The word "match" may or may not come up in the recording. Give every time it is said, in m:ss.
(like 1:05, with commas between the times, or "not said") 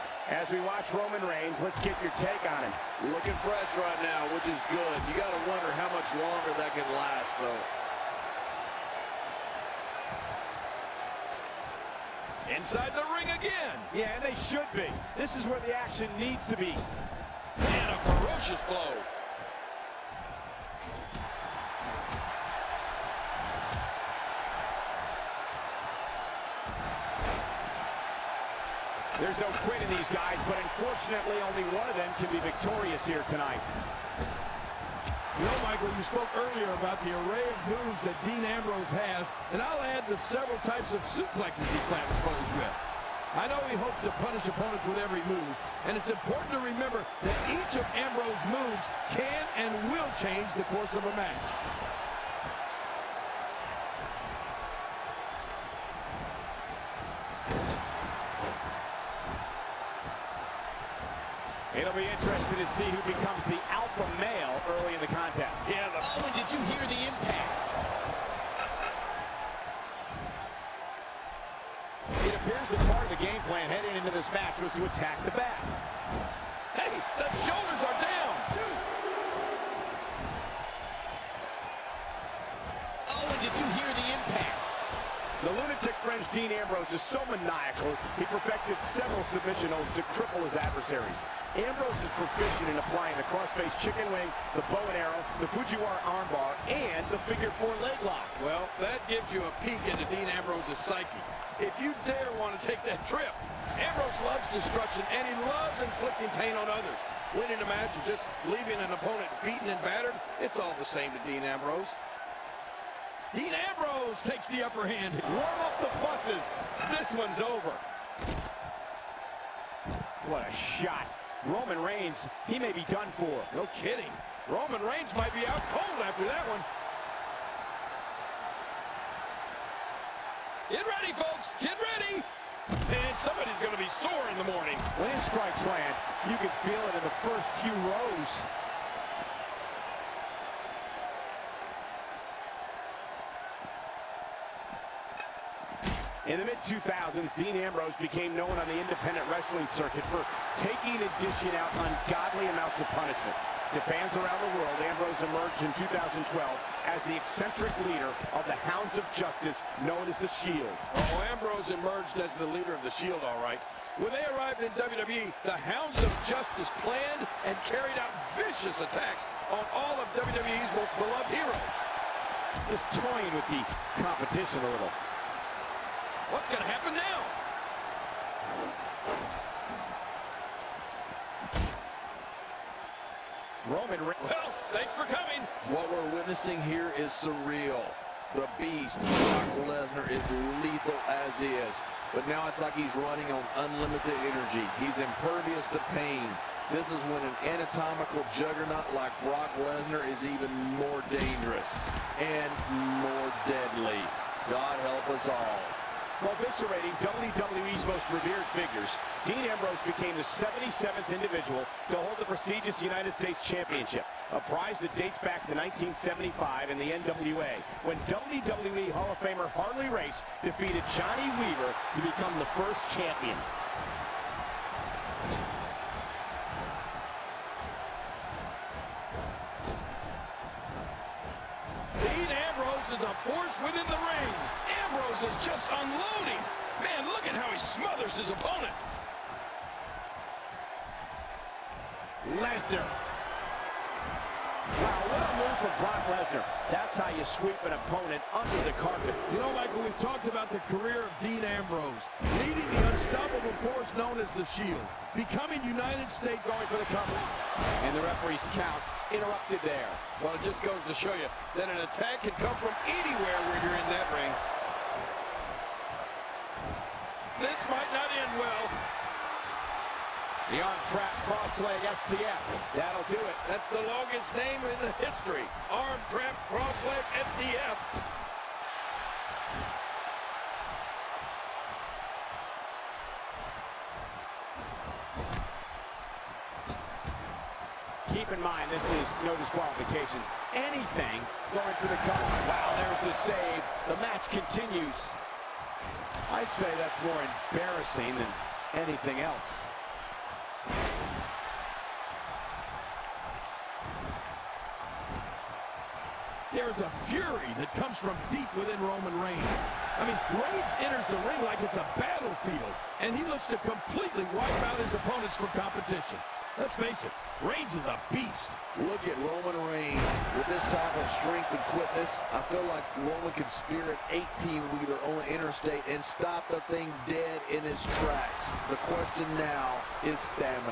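0:51, 1:14, 1:47, 4:53.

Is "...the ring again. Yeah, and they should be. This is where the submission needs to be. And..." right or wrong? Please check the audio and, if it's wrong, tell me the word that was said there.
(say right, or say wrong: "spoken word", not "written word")
wrong: "action", not "submission".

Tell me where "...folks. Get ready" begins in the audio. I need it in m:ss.
2:11.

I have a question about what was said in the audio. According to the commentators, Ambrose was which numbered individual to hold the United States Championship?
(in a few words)
77th.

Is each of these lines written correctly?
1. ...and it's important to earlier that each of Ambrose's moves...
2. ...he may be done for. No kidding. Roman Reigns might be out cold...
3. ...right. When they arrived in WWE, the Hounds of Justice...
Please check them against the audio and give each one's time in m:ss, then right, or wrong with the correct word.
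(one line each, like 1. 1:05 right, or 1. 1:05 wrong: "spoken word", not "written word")
1. 0:45 wrong: "remember", not "earlier"
2. 2:02 right
3. 2:43 right.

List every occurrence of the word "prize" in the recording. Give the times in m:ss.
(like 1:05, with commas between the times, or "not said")
3:34.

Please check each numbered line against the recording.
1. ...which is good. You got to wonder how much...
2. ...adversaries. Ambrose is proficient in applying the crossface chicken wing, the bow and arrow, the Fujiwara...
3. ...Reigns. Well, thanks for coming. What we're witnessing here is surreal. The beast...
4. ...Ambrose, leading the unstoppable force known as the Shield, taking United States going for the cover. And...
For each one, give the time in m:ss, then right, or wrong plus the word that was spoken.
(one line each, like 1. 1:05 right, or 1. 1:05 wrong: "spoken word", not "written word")
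1. 0:04 right
2. 1:30 right
3. 3:04 right
4. 4:11 wrong: "becoming", not "taking".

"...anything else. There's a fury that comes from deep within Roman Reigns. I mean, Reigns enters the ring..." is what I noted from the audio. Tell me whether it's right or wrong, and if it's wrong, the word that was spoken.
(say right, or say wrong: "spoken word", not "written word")
right.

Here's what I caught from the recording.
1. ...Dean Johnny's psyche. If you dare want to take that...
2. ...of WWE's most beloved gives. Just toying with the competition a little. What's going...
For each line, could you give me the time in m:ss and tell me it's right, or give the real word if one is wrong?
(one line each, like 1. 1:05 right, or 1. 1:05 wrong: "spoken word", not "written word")
1. 1:40 wrong: "Ambrose", not "Johnny"
2. 2:49 wrong: "heroes", not "gives".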